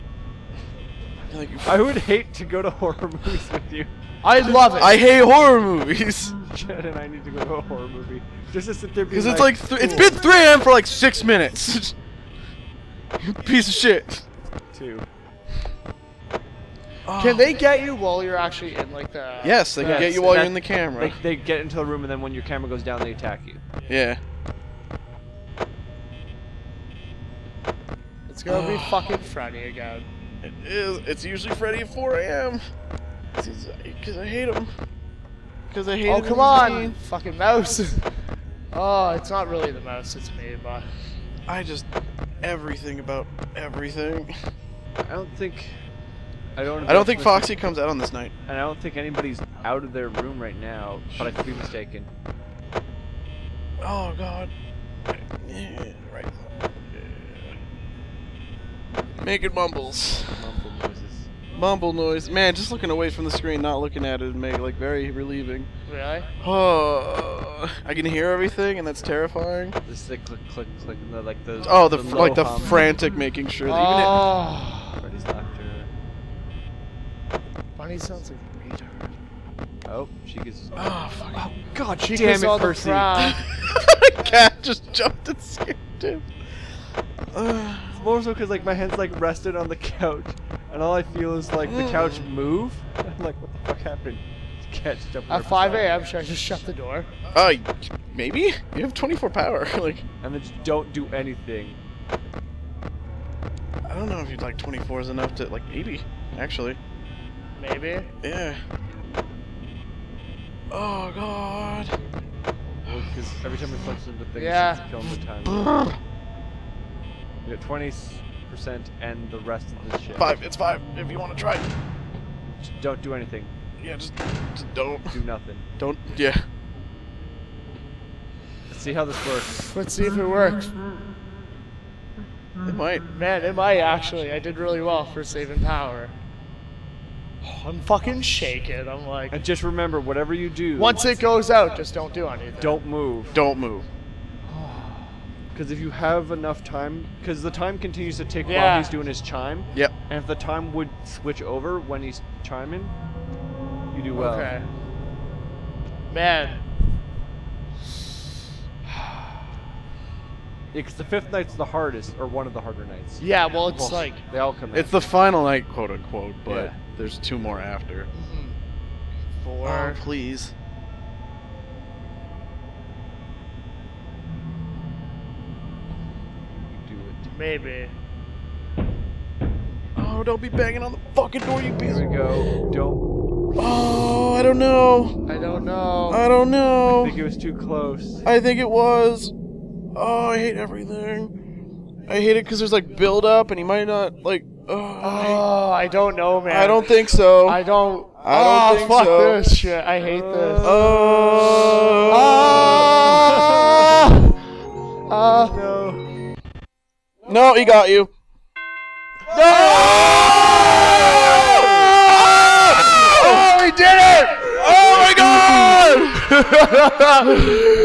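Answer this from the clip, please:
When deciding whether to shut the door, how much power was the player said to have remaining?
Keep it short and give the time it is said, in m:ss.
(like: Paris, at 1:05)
24, at 1:38.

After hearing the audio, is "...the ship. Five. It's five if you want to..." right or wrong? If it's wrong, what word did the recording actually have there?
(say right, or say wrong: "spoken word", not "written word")
right.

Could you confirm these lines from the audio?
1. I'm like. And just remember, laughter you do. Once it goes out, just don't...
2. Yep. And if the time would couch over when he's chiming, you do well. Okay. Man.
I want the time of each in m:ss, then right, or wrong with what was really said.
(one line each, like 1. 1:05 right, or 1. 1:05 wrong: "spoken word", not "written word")
1. 2:18 wrong: "whatever", not "laughter"
2. 2:29 wrong: "switch", not "couch".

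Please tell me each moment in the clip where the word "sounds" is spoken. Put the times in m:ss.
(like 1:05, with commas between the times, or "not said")
1:17.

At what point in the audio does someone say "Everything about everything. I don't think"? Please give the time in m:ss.
0:42.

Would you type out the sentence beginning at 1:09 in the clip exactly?
This the click, click, click, and the, like the.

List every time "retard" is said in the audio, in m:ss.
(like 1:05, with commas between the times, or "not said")
1:18.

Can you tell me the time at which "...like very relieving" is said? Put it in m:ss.
1:04.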